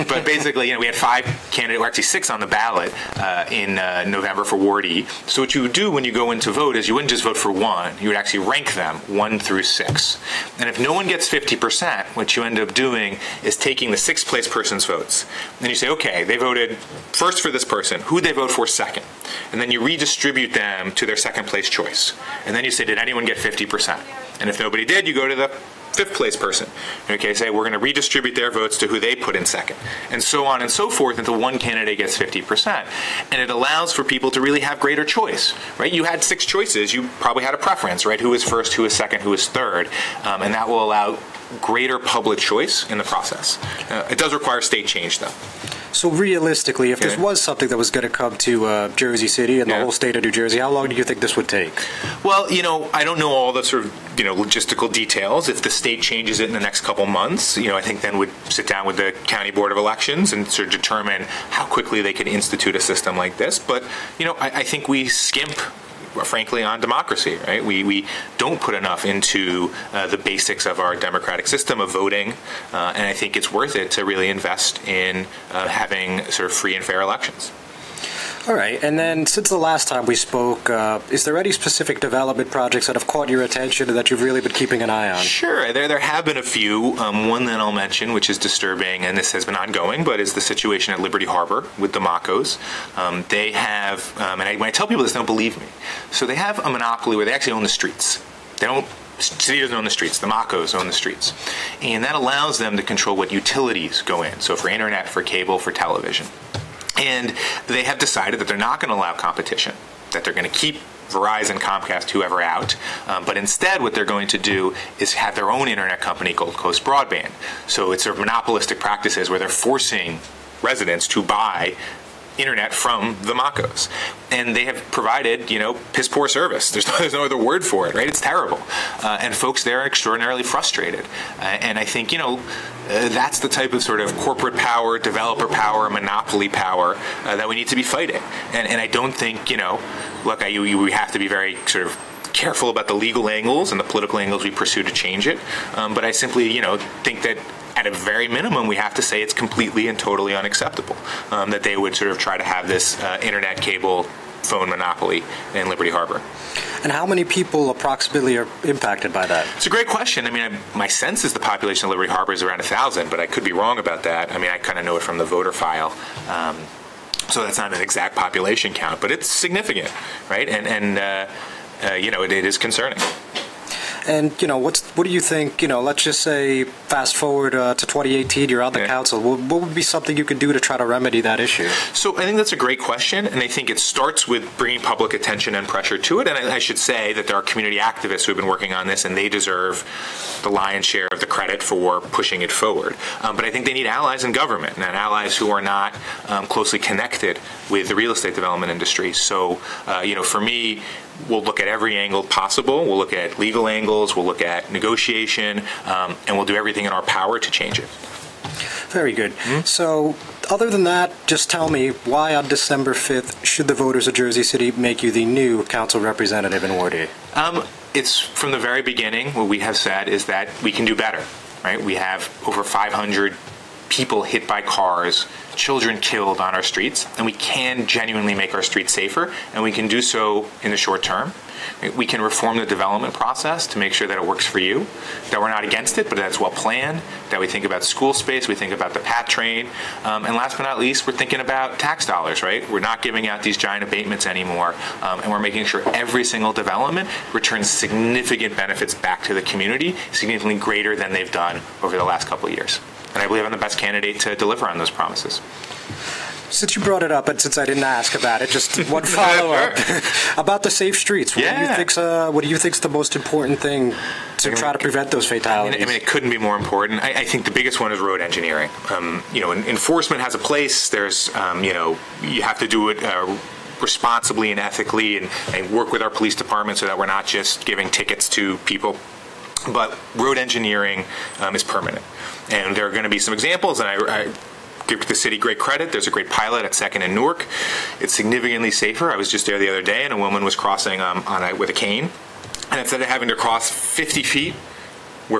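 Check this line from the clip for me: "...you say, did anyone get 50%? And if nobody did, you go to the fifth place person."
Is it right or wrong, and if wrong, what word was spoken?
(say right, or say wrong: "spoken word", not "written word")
right.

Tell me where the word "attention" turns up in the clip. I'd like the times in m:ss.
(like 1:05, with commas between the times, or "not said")
1:23, 3:05.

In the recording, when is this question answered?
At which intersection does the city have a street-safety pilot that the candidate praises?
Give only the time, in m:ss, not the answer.
4:46.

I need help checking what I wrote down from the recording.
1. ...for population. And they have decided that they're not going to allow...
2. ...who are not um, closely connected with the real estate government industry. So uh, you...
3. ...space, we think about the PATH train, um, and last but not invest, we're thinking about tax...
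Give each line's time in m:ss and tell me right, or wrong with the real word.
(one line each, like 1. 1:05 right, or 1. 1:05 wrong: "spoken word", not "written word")
1. 1:45 wrong: "television", not "population"
2. 3:15 wrong: "development", not "government"
3. 3:58 wrong: "least", not "invest".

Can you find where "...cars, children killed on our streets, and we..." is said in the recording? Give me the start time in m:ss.
3:44.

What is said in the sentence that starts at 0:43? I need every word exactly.
Uh, it does require state change, though.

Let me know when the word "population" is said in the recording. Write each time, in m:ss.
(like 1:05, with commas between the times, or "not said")
2:41, 2:48.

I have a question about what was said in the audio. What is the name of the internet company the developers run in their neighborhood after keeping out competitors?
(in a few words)
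Gold Coast Broadband.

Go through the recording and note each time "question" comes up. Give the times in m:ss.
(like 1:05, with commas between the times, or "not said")
2:39, 3:02.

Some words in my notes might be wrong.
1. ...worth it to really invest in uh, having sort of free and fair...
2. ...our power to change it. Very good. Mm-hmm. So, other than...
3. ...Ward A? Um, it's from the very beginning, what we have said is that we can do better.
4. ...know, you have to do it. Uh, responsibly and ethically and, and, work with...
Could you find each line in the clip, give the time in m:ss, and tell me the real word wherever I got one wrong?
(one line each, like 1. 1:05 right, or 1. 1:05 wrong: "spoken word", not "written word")
1. 1:13 right
2. 3:26 right
3. 3:36 right
4. 4:31 right.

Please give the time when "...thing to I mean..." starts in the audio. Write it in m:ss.
4:23.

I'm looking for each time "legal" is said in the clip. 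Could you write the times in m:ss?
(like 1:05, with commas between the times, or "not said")
2:22, 3:23.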